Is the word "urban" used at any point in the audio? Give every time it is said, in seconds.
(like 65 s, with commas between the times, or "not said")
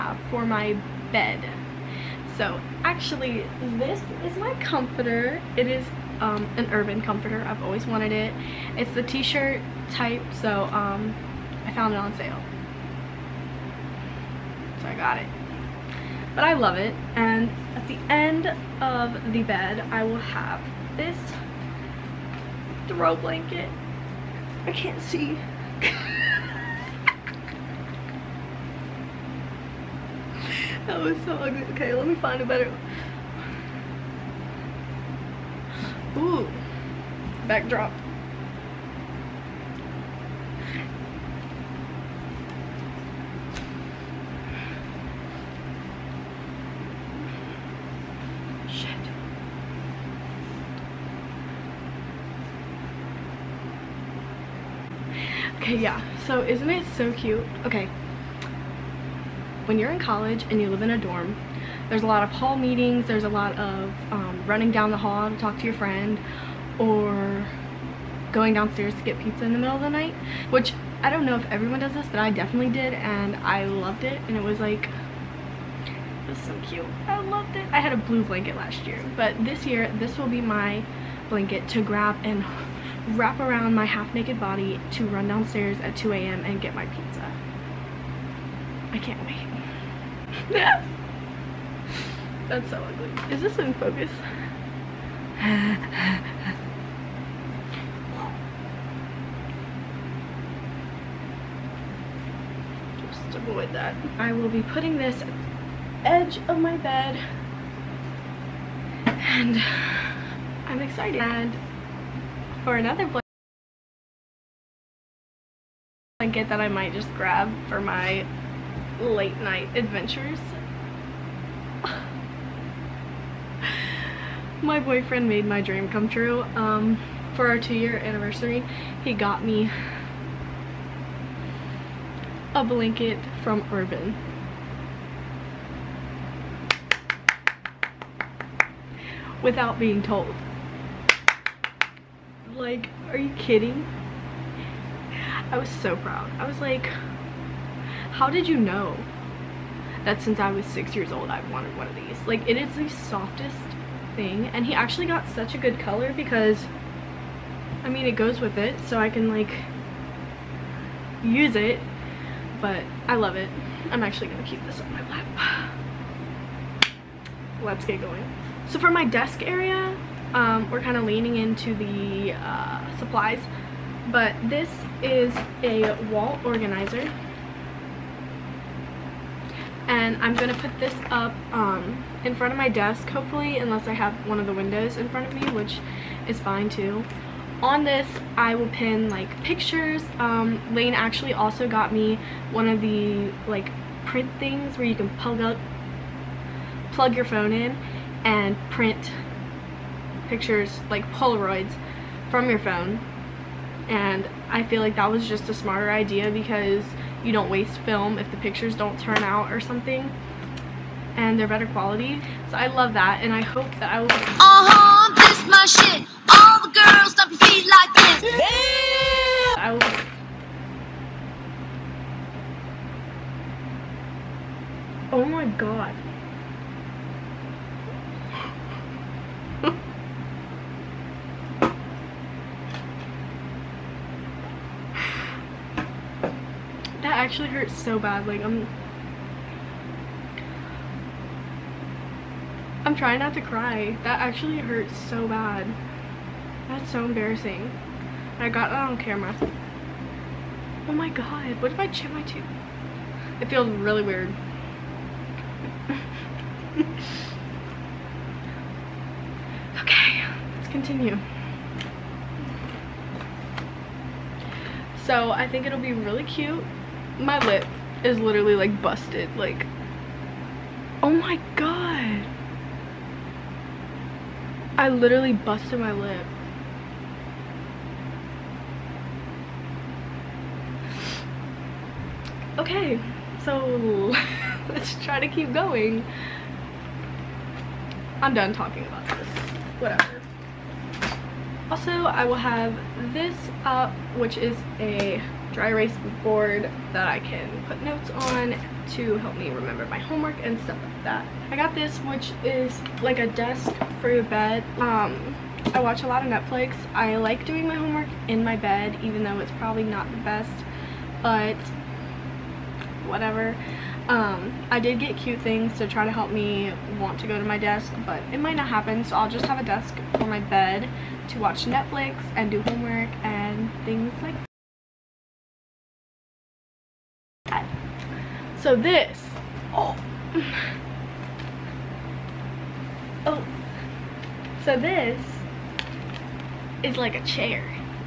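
6 s, 133 s.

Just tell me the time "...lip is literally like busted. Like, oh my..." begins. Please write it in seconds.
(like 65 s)
267 s.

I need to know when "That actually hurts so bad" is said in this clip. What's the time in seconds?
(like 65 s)
244 s.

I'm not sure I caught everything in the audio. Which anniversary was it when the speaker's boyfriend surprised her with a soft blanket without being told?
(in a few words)
Two year.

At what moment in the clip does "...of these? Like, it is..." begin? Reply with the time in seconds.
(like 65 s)
151 s.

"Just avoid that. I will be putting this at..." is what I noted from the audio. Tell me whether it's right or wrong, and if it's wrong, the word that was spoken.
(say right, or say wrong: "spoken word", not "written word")
right.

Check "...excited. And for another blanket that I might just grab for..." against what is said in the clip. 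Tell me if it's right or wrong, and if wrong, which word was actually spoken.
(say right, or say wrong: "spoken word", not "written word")
right.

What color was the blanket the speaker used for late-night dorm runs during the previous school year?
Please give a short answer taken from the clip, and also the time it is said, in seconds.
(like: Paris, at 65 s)
Blue, at 77 s.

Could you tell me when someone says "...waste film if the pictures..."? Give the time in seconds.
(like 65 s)
207 s.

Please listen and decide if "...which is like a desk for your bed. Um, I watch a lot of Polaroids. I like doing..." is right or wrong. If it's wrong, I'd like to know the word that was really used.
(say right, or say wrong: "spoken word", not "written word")
wrong: "Netflix", not "Polaroids".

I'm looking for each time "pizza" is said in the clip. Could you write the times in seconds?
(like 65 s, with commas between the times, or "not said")
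69 s, 86 s.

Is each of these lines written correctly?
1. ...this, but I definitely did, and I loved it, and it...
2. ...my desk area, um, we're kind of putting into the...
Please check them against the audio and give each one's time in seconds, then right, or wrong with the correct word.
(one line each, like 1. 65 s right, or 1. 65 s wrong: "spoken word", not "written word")
1. 71 s right
2. 168 s wrong: "leaning", not "putting".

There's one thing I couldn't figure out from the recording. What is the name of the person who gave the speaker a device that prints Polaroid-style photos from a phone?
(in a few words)
Lane.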